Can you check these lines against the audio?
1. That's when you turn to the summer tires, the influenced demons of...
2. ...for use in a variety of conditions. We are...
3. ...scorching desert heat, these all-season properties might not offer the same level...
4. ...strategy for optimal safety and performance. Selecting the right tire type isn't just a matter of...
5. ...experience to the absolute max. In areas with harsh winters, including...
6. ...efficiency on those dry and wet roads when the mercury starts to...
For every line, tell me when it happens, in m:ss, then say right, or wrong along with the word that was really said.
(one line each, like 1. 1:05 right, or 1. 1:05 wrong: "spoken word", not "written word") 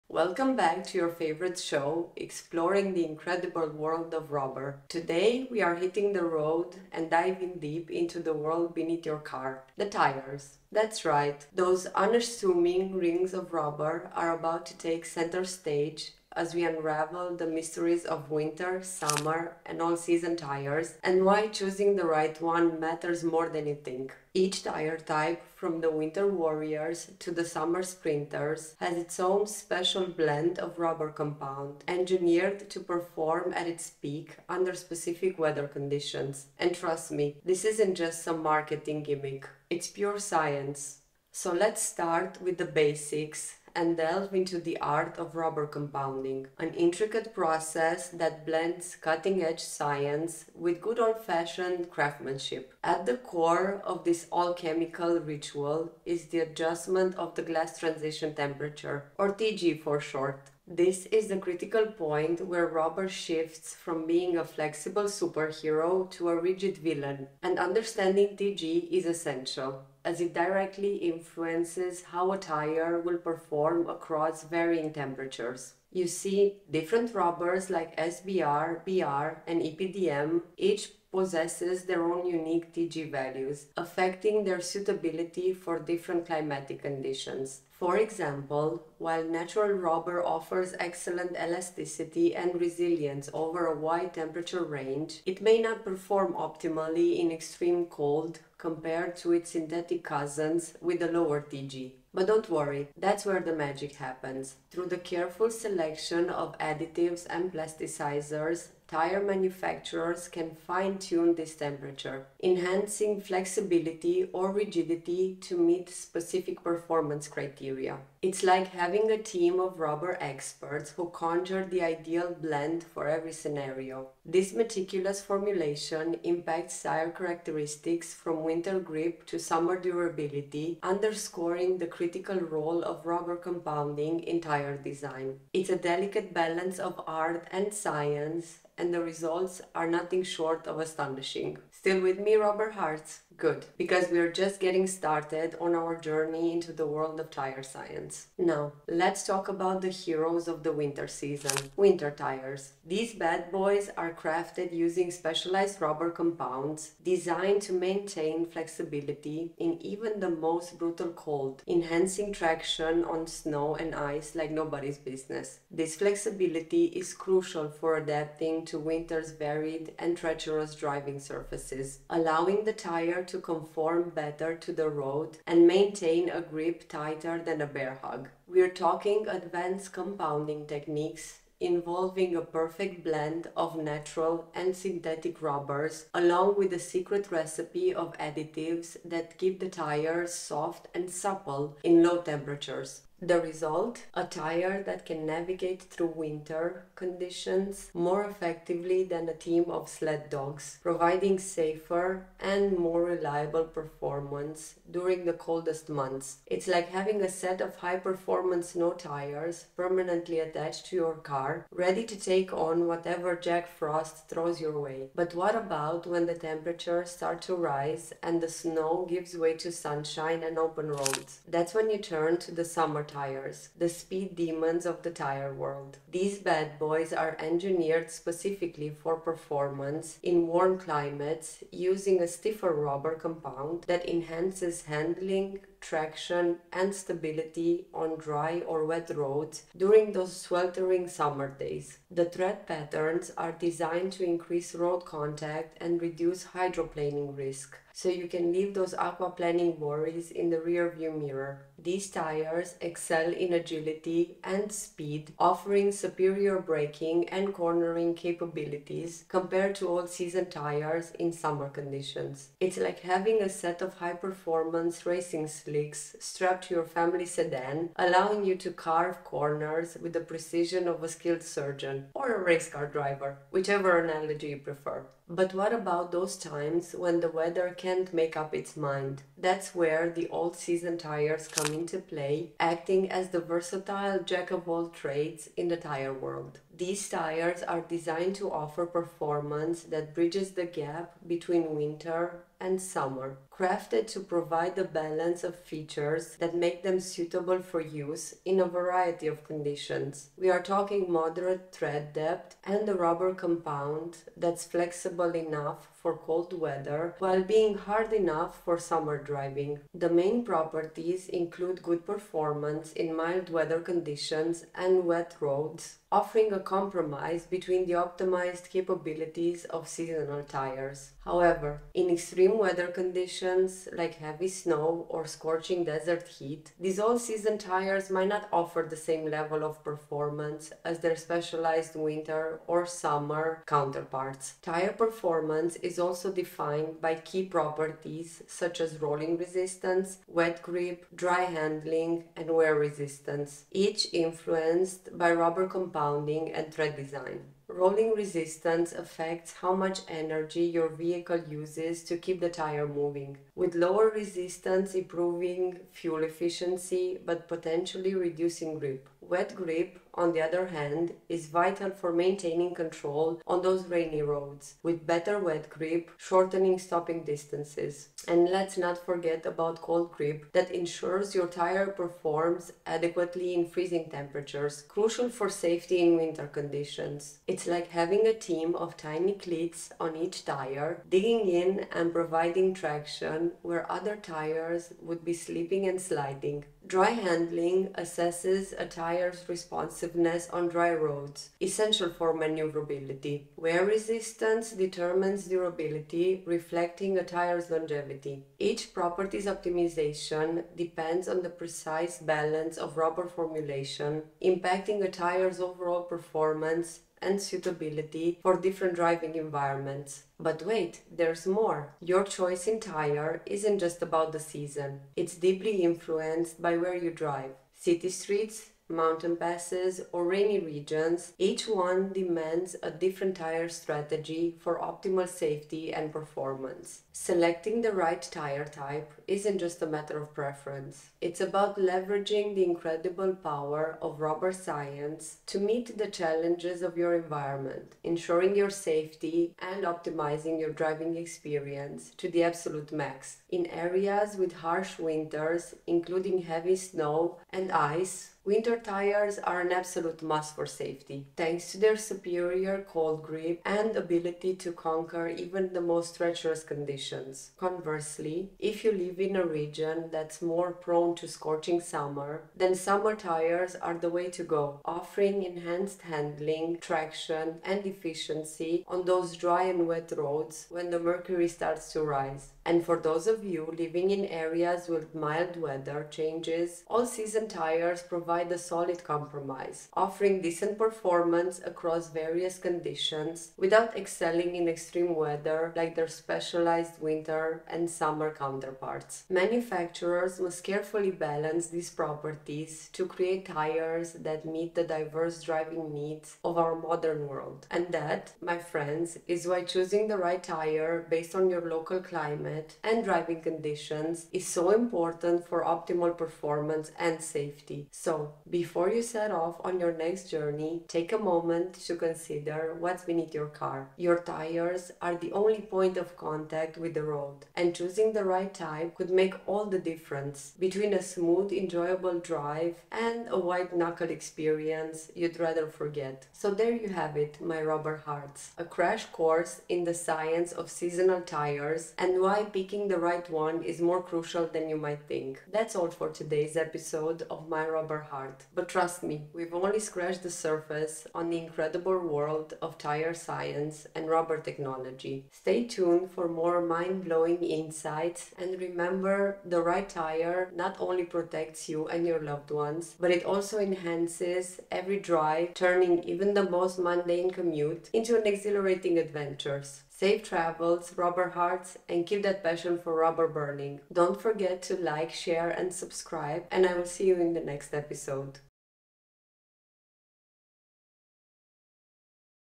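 1. 3:41 wrong: "speed", not "influenced"
2. 4:57 right
3. 5:25 wrong: "tires", not "properties"
4. 7:03 right
5. 7:21 right
6. 7:47 right.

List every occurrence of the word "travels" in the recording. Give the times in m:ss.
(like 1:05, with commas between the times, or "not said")
9:20.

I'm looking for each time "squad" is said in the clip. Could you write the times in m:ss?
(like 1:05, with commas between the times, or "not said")
not said.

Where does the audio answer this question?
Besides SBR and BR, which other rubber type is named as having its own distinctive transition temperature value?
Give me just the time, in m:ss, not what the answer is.
1:19.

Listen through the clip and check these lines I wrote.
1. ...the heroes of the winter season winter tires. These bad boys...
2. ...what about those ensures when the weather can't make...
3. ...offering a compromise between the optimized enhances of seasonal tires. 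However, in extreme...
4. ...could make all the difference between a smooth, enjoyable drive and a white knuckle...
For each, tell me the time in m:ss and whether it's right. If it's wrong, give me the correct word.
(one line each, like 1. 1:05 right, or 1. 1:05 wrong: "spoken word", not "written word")
1. 2:29 right
2. 4:35 wrong: "times", not "ensures"
3. 5:16 wrong: "capabilities", not "enhances"
4. 8:38 right.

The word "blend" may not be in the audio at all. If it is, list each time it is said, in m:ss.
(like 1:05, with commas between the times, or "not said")
0:30, 0:48, 2:02, 3:03.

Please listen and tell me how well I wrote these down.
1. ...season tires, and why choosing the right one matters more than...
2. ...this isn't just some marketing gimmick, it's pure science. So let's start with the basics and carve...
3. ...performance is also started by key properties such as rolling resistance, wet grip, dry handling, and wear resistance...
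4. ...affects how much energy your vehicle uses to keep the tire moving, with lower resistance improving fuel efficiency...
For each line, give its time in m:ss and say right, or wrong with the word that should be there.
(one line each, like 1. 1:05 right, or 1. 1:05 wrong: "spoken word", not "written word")
1. 0:19 right
2. 0:37 wrong: "delve", not "carve"
3. 5:34 wrong: "defined", not "started"
4. 5:48 right.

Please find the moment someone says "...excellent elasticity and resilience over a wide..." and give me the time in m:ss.
1:30.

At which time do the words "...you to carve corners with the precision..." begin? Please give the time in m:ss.
4:28.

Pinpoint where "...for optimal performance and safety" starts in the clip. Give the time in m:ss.
8:25.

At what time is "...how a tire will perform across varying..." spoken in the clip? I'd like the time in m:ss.
1:12.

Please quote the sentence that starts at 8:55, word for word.
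That's all for today's episode of My Rubber Hearts.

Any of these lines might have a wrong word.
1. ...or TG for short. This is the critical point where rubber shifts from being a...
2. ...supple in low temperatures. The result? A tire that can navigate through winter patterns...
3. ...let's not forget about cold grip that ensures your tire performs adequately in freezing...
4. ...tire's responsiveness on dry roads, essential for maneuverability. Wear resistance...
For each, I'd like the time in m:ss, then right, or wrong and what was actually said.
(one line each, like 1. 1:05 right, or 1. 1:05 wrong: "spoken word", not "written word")
1. 0:59 right
2. 3:11 wrong: "conditions", not "patterns"
3. 6:08 right
4. 6:28 right.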